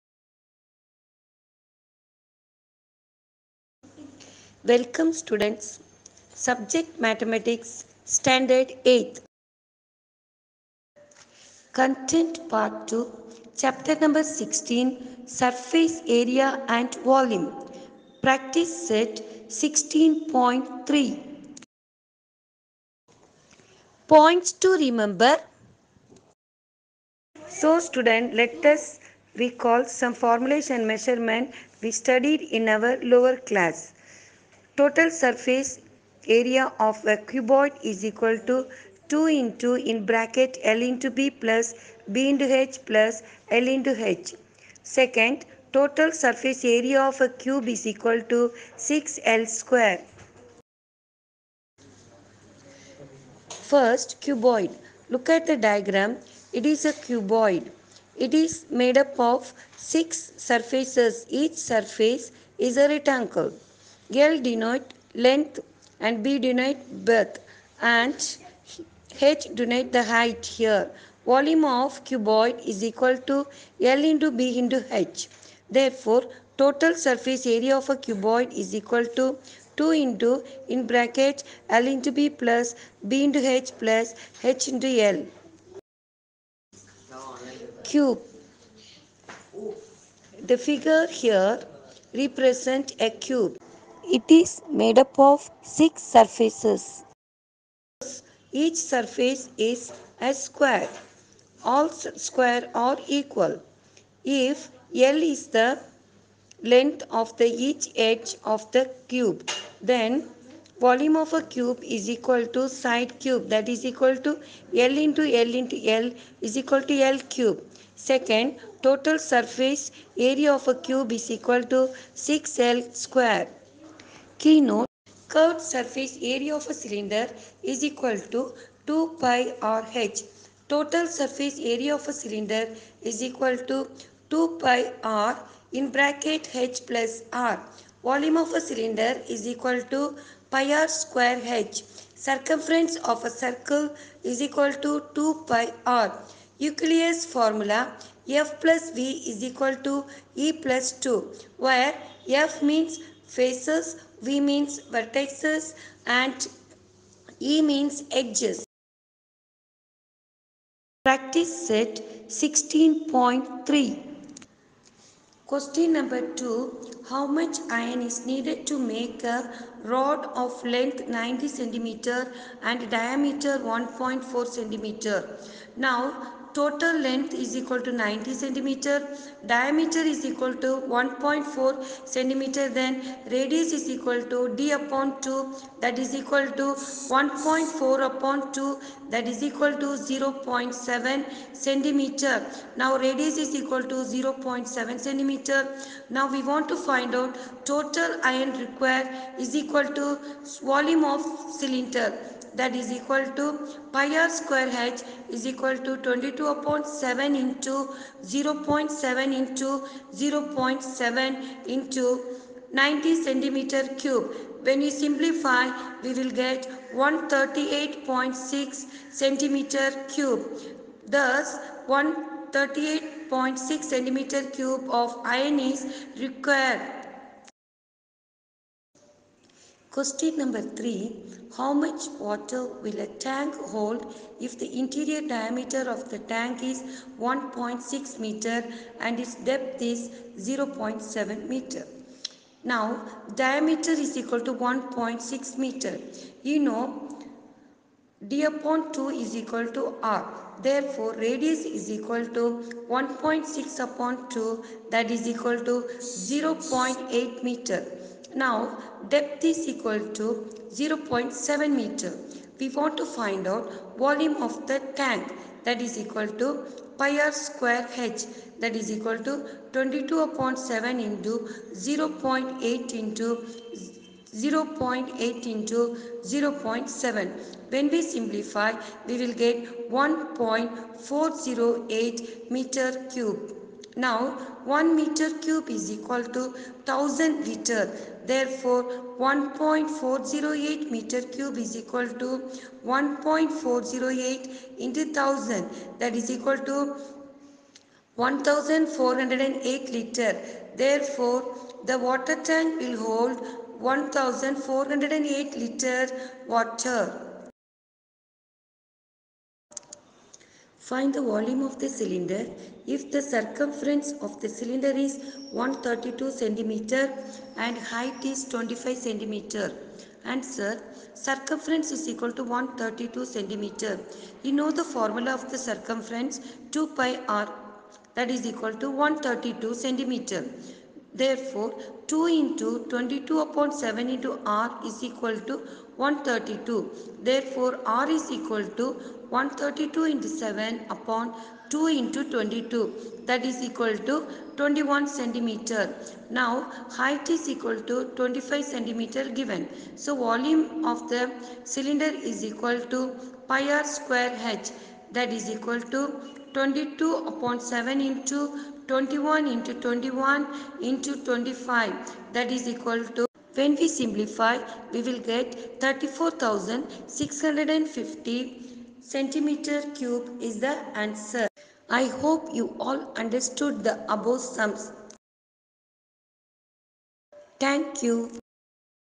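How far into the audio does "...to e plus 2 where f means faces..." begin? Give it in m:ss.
2:29.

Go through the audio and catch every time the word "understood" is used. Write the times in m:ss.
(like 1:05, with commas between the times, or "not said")
6:13.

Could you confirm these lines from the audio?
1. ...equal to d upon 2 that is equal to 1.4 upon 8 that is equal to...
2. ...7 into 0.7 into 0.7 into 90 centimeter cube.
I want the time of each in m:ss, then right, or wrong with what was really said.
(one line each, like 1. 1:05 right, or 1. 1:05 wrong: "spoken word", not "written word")
1. 3:03 wrong: "2", not "8"
2. 3:26 right.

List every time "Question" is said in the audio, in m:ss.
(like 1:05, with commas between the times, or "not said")
2:45, 3:49.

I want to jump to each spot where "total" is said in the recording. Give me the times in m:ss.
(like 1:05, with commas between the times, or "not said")
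0:34, 0:45, 1:16, 1:58, 2:10, 2:56, 3:17.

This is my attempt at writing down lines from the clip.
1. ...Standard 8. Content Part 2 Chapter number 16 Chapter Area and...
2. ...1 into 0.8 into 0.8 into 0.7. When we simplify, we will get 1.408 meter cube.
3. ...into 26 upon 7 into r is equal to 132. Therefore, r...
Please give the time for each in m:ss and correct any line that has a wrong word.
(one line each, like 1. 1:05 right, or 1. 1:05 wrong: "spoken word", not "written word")
1. 0:08 wrong: "Surface", not "Chapter"
2. 4:30 wrong: "7", not "1"
3. 5:32 wrong: "22", not "26".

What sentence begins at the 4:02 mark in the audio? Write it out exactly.
Now, diameter is equal to 1.6 meter.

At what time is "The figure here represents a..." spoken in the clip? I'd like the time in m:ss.
1:30.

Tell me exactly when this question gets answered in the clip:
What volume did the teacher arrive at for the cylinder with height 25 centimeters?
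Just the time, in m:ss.
6:05.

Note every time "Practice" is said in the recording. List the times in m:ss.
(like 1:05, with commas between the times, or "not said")
0:18, 2:41.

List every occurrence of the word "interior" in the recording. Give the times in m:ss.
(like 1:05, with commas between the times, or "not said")
3:54.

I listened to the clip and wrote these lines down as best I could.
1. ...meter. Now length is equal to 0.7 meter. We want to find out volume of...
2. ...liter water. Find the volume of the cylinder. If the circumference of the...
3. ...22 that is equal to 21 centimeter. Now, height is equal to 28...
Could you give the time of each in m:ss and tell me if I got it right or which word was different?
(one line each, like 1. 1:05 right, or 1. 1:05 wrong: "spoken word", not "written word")
1. 4:17 wrong: "depth", not "length"
2. 5:05 right
3. 5:42 wrong: "25", not "28".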